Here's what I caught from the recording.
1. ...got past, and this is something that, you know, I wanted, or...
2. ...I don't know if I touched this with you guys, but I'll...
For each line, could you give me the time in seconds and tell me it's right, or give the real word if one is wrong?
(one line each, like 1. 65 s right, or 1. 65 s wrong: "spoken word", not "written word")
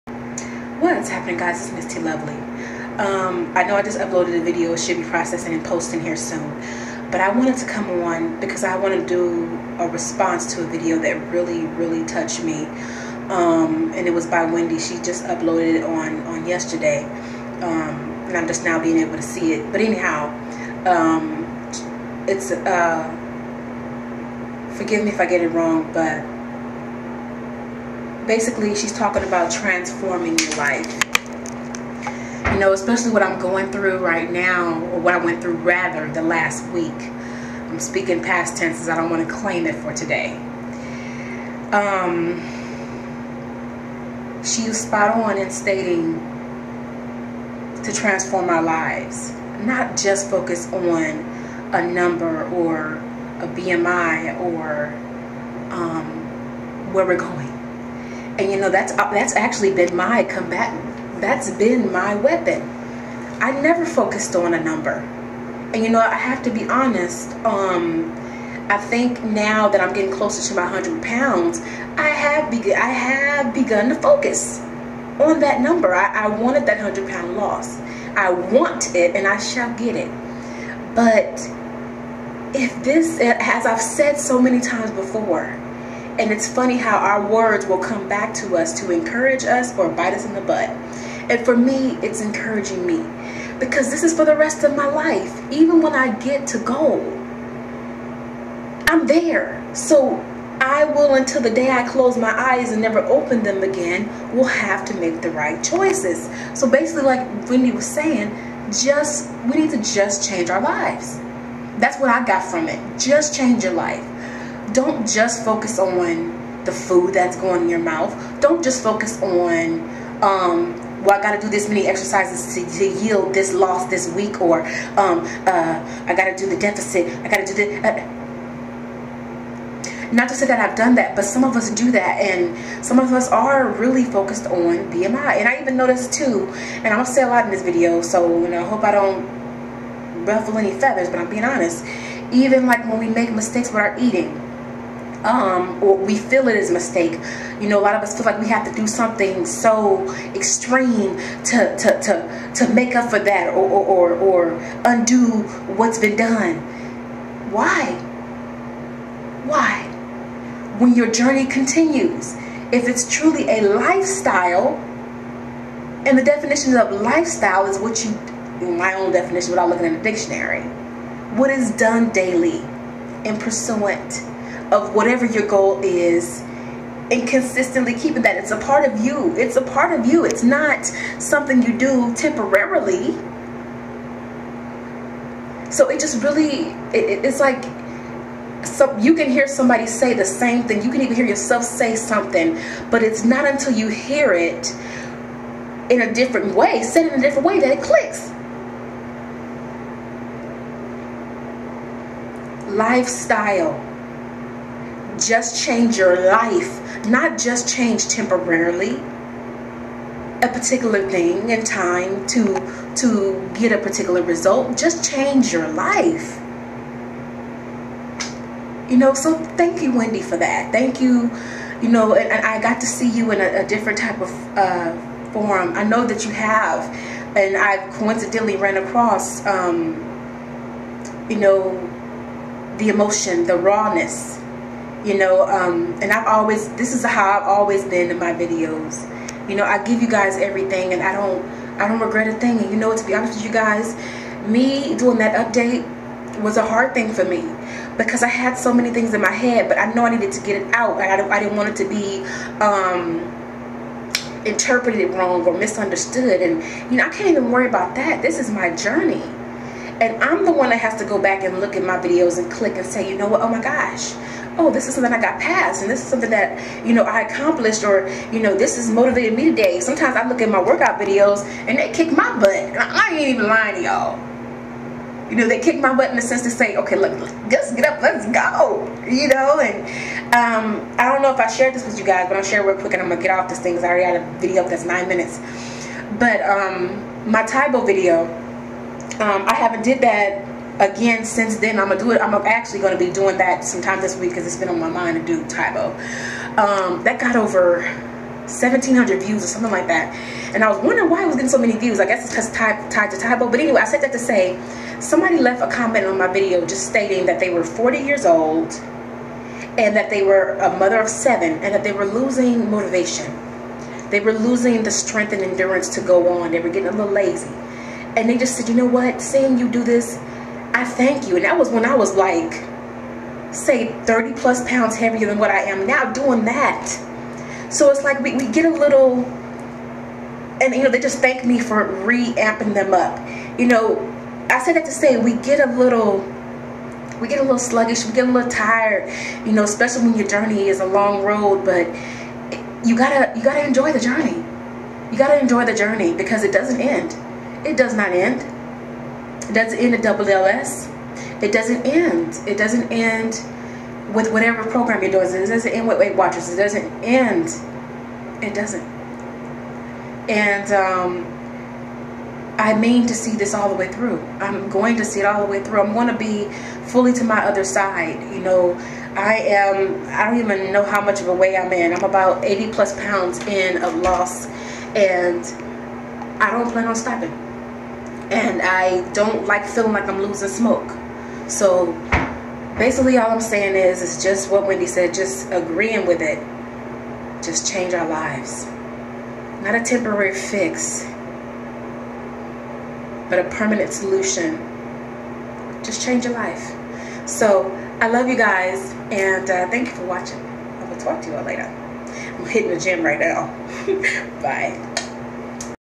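1. 265 s wrong: "accomplished", not "wanted"
2. 280 s wrong: "shared", not "touched".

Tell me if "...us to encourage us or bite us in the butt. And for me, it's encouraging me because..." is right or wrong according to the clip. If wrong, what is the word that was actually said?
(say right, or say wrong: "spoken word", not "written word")
right.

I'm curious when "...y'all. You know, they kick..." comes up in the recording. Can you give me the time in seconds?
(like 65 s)
273 s.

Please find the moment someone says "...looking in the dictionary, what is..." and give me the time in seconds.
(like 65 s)
169 s.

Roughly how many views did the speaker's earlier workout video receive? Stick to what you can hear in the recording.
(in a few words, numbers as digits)
1,700.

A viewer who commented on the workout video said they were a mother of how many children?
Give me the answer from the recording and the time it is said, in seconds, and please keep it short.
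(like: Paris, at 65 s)
7, at 311 s.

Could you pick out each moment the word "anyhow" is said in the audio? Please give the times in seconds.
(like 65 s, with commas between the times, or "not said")
19 s.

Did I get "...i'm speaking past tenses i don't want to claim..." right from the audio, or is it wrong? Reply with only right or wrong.
right.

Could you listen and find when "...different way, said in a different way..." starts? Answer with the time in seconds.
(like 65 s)
196 s.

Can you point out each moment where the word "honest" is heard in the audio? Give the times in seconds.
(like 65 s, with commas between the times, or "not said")
66 s, 141 s, 243 s.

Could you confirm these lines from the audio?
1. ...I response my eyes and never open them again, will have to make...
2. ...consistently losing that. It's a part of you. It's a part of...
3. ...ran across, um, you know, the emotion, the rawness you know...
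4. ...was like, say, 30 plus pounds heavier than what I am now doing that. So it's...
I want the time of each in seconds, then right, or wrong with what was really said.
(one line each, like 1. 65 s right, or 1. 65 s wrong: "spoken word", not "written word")
1. 101 s wrong: "close", not "response"
2. 177 s wrong: "keeping", not "losing"
3. 228 s right
4. 321 s right.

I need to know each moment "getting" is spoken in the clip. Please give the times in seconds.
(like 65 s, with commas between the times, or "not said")
69 s, 301 s, 316 s.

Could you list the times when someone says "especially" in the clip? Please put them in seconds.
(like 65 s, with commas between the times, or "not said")
32 s, 339 s.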